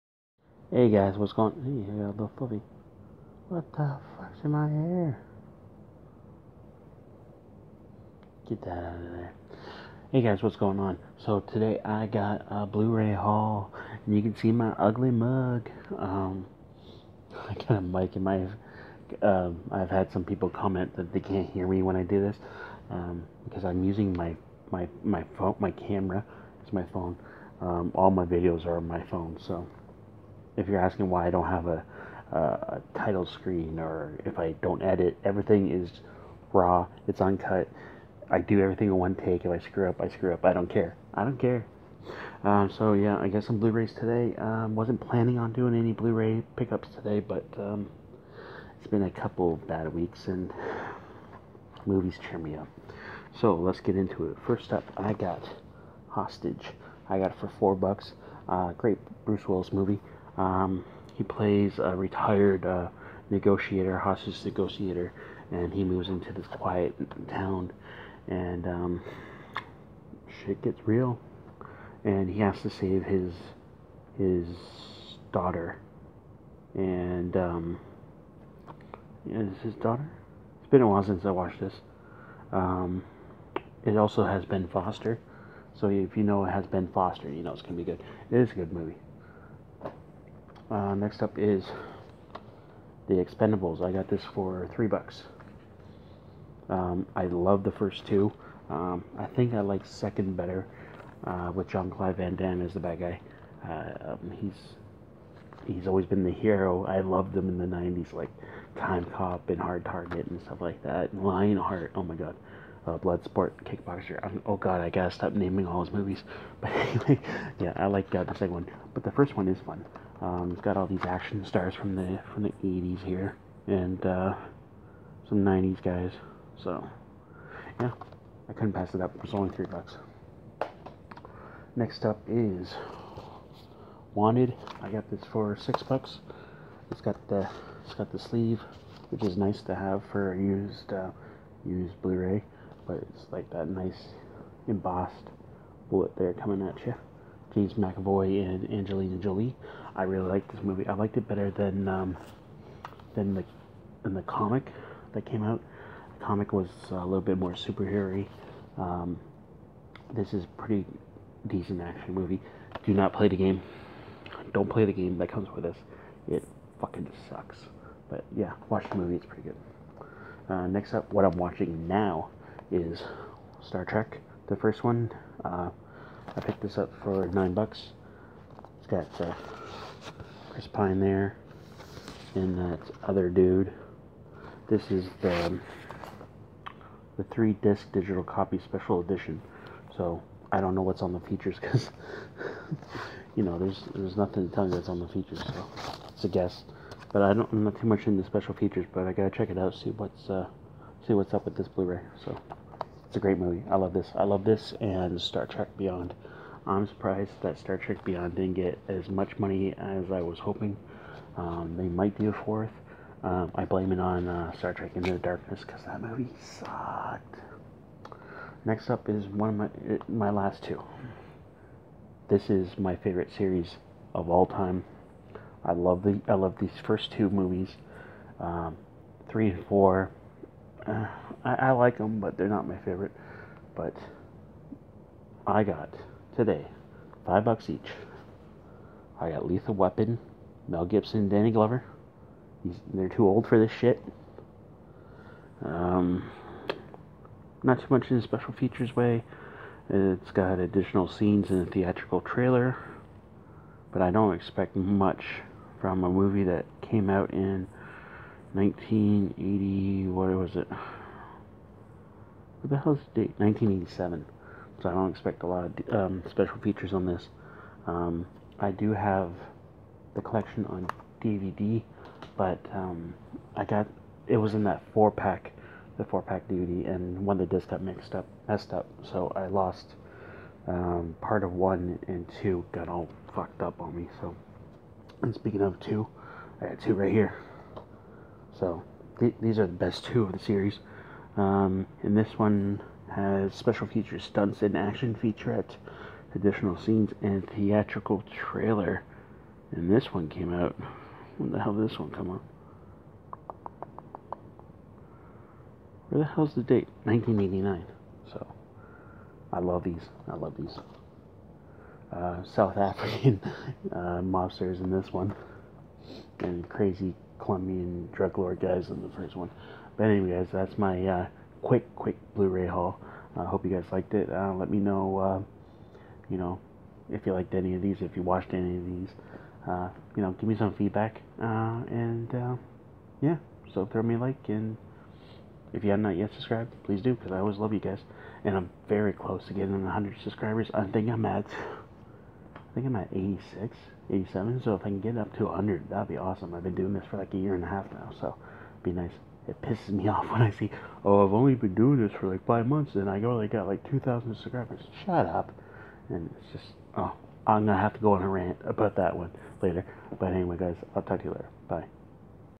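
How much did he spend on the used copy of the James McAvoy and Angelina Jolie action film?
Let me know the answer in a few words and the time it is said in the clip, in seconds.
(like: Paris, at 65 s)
$6, at 135 s.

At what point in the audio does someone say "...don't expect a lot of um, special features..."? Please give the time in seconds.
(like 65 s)
264 s.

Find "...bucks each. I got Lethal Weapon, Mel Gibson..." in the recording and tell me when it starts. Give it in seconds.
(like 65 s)
237 s.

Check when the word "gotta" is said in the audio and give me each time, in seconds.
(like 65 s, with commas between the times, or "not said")
114 s, 199 s.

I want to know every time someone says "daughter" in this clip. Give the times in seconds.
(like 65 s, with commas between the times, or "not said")
75 s, 79 s.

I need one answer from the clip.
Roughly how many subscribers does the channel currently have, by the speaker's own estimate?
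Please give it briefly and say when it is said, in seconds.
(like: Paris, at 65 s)
86 or 87, at 343 s.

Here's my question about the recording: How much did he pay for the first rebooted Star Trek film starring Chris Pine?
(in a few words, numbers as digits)
$9.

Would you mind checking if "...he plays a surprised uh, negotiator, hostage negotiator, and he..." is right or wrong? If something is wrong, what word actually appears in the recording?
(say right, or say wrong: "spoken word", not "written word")
wrong: "retired", not "surprised".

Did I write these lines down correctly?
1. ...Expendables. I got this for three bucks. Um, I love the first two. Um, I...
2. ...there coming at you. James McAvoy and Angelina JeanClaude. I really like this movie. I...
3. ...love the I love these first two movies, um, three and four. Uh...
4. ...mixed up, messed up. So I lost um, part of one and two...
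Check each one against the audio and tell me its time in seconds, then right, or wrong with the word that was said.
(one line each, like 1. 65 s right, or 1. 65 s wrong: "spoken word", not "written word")
1. 93 s right
2. 146 s wrong: "Jolie", not "JeanClaude"
3. 225 s right
4. 277 s right.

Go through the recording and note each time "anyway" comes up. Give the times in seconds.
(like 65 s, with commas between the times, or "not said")
116 s, 320 s, 360 s.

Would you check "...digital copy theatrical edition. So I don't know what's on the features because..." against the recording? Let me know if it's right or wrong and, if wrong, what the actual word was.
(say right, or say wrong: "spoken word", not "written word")
wrong: "special", not "theatrical".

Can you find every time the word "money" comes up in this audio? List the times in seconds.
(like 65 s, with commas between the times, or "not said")
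209 s.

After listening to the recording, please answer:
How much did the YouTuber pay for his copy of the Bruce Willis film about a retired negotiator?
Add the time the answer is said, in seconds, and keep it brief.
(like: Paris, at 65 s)
$4, at 57 s.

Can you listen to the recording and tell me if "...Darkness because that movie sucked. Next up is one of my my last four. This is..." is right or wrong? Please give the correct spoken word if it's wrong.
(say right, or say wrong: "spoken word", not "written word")
wrong: "two", not "four".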